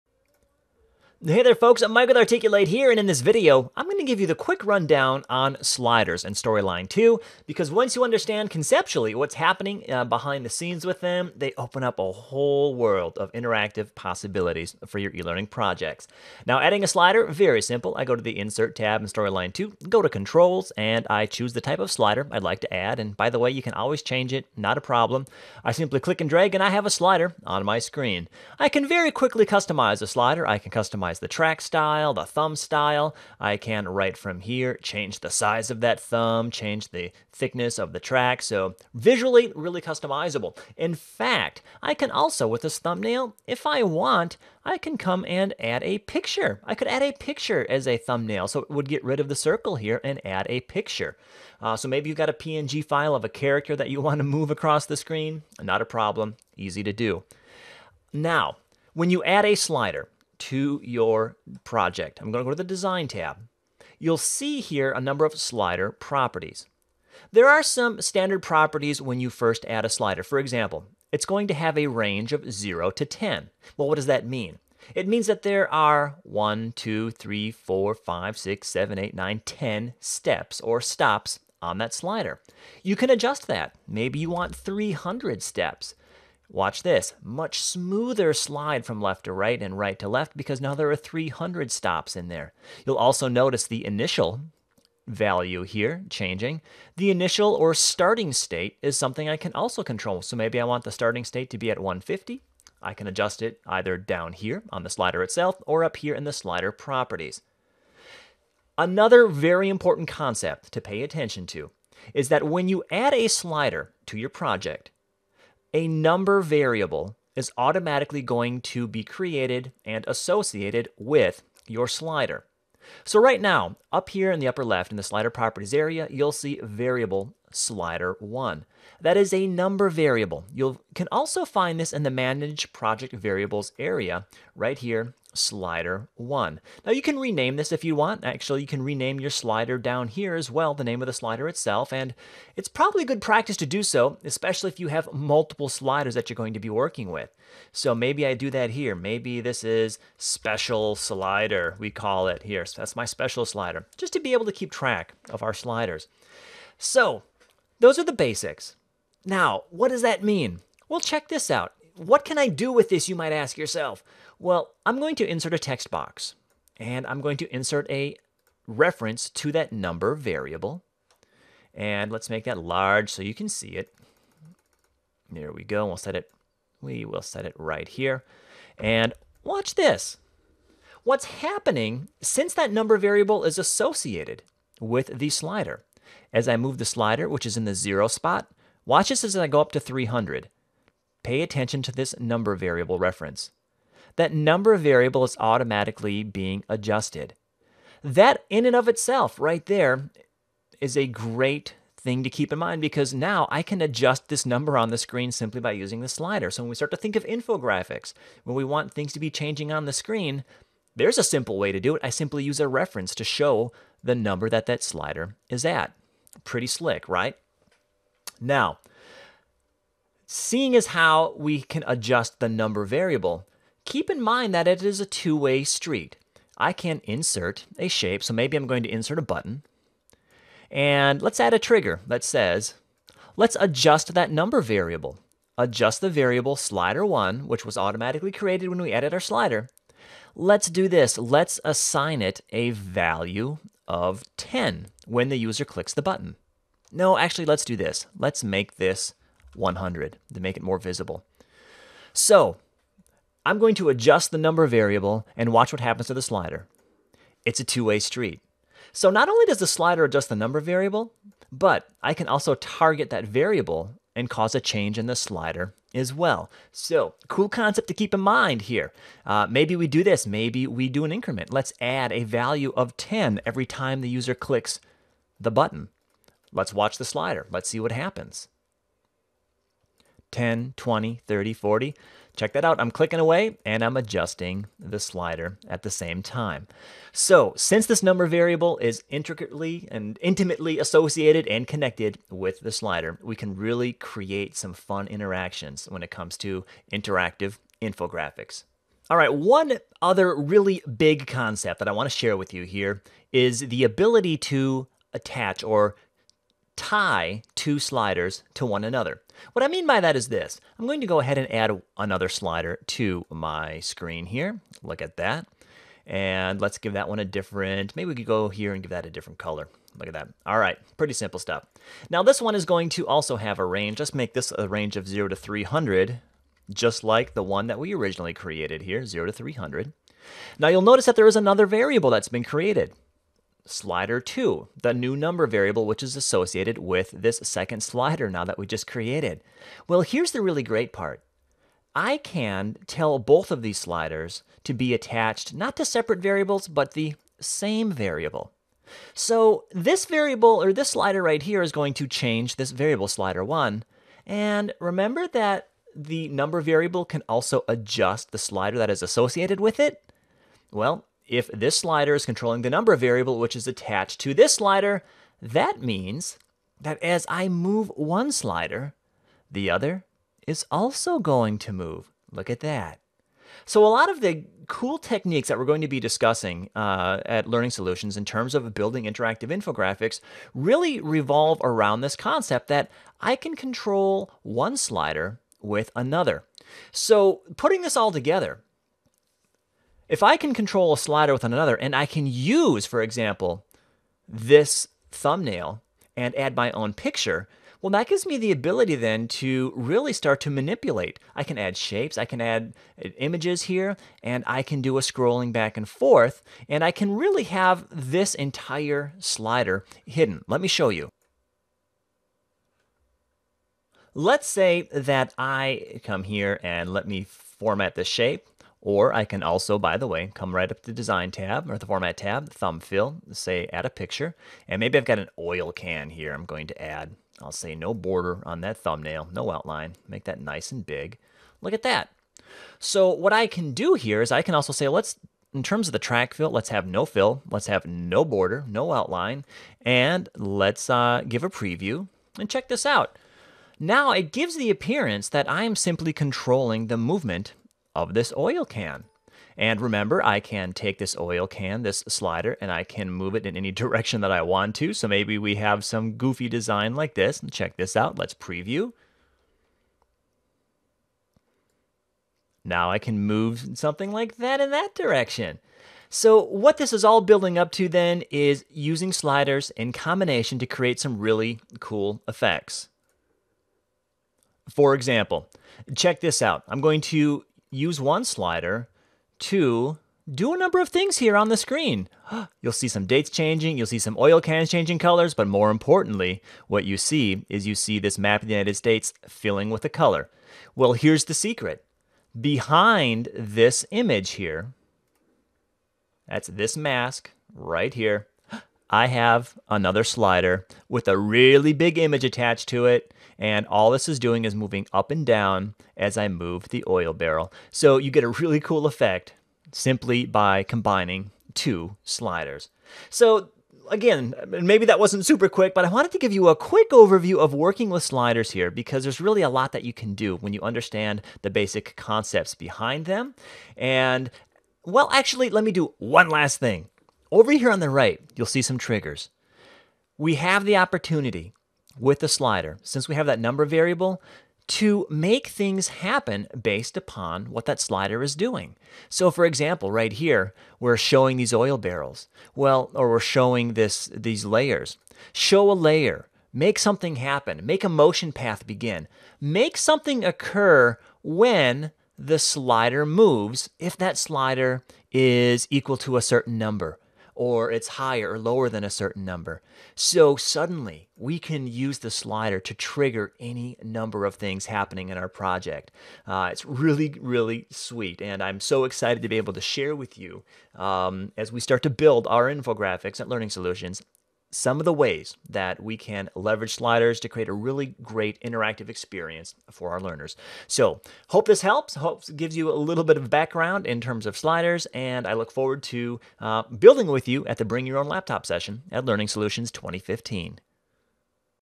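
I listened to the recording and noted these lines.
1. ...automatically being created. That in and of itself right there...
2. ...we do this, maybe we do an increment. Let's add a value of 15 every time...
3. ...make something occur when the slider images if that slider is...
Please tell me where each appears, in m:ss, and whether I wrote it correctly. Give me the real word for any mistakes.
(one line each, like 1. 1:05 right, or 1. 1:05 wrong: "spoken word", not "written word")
1. 3:15 wrong: "adjusted", not "created"
2. 4:29 wrong: "10", not "15"
3. 9:09 wrong: "moves", not "images".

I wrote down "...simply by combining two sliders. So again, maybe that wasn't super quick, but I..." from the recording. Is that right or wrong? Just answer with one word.
right.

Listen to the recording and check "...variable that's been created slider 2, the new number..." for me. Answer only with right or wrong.
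right.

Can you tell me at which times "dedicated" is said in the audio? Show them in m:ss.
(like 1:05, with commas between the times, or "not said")
not said.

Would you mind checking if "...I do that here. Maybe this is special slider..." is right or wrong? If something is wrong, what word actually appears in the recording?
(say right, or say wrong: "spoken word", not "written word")
right.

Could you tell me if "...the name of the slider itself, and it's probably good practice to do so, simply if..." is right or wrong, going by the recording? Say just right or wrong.
wrong.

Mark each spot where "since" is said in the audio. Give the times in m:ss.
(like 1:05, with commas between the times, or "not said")
3:02, 4:47, 8:52.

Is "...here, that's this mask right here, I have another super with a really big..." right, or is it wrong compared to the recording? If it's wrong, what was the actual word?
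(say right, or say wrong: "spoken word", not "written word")
wrong: "slider", not "super".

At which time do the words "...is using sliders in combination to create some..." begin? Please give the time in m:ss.
7:48.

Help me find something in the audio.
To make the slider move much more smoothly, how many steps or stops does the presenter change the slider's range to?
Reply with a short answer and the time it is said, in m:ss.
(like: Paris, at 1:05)
300, at 1:23.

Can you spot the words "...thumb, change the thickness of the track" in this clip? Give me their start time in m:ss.
0:35.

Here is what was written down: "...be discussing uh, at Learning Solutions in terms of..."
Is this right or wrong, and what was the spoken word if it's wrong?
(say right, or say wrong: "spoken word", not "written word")
right.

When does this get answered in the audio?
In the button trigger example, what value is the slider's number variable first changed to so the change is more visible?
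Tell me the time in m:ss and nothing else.
4:08.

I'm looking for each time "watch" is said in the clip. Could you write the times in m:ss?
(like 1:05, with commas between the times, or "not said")
1:26, 2:59, 3:08, 4:15, 4:36.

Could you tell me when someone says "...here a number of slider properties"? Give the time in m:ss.
1:04.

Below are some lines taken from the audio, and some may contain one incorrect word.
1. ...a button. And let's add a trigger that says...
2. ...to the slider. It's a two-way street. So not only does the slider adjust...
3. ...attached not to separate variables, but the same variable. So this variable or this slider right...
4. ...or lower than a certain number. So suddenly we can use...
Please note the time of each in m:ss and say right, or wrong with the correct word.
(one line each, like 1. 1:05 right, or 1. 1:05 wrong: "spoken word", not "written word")
1. 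3:49 right
2. 4:16 right
3. 5:44 right
4. 9:18 right.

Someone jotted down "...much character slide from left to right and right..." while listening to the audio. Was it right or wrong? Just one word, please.
wrong.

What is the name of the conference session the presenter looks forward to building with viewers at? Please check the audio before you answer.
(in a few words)
Bring Your Own Laptop.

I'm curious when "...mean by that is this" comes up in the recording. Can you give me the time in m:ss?
5:09.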